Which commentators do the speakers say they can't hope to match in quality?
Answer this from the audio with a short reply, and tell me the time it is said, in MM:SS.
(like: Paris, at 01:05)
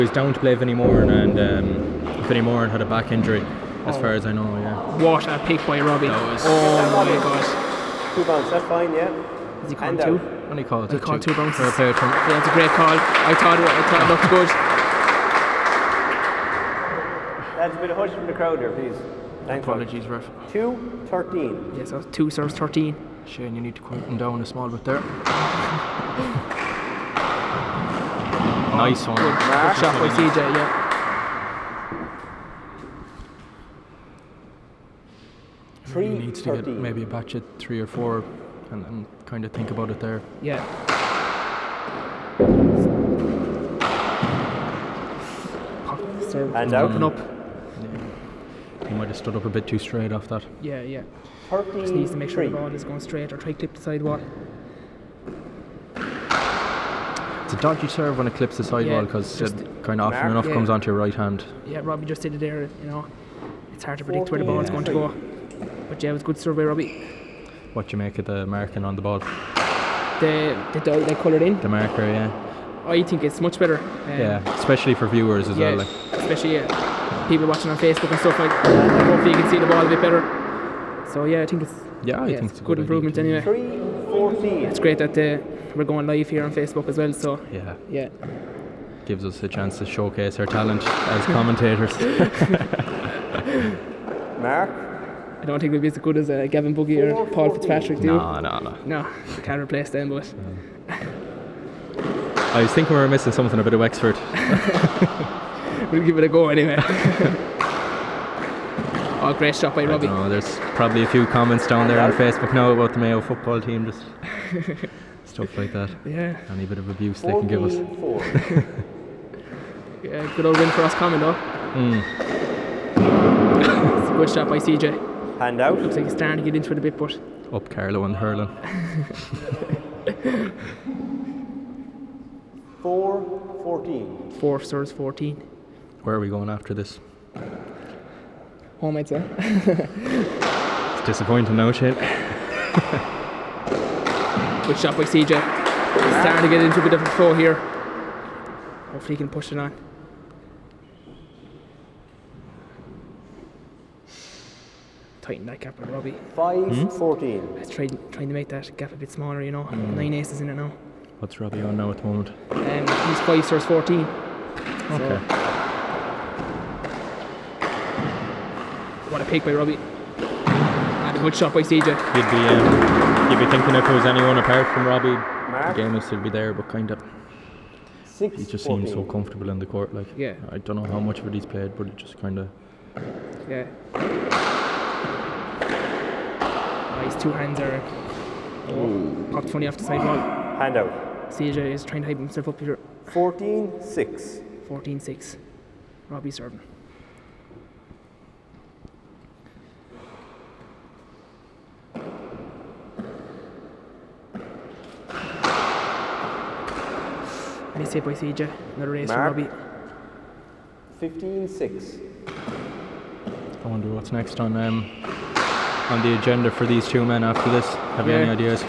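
Gavin Boogie or Paul Fitzpatrick, at 01:36.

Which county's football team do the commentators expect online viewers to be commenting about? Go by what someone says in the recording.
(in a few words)
Mayo.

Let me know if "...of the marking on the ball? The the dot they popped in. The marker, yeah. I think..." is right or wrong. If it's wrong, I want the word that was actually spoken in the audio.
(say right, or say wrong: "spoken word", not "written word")
wrong: "coloured", not "popped".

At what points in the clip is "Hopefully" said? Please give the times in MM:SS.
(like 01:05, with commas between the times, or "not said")
01:19, 02:28.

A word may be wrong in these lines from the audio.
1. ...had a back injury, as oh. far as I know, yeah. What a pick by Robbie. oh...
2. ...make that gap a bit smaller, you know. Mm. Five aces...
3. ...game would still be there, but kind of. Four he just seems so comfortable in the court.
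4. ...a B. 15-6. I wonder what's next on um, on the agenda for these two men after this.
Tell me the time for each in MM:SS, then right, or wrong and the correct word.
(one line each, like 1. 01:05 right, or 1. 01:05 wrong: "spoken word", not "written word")
1. 00:02 right
2. 02:38 wrong: "Nine", not "Five"
3. 02:55 wrong: "Six", not "Four"
4. 03:29 right.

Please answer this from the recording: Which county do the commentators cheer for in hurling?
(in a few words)
Carlow.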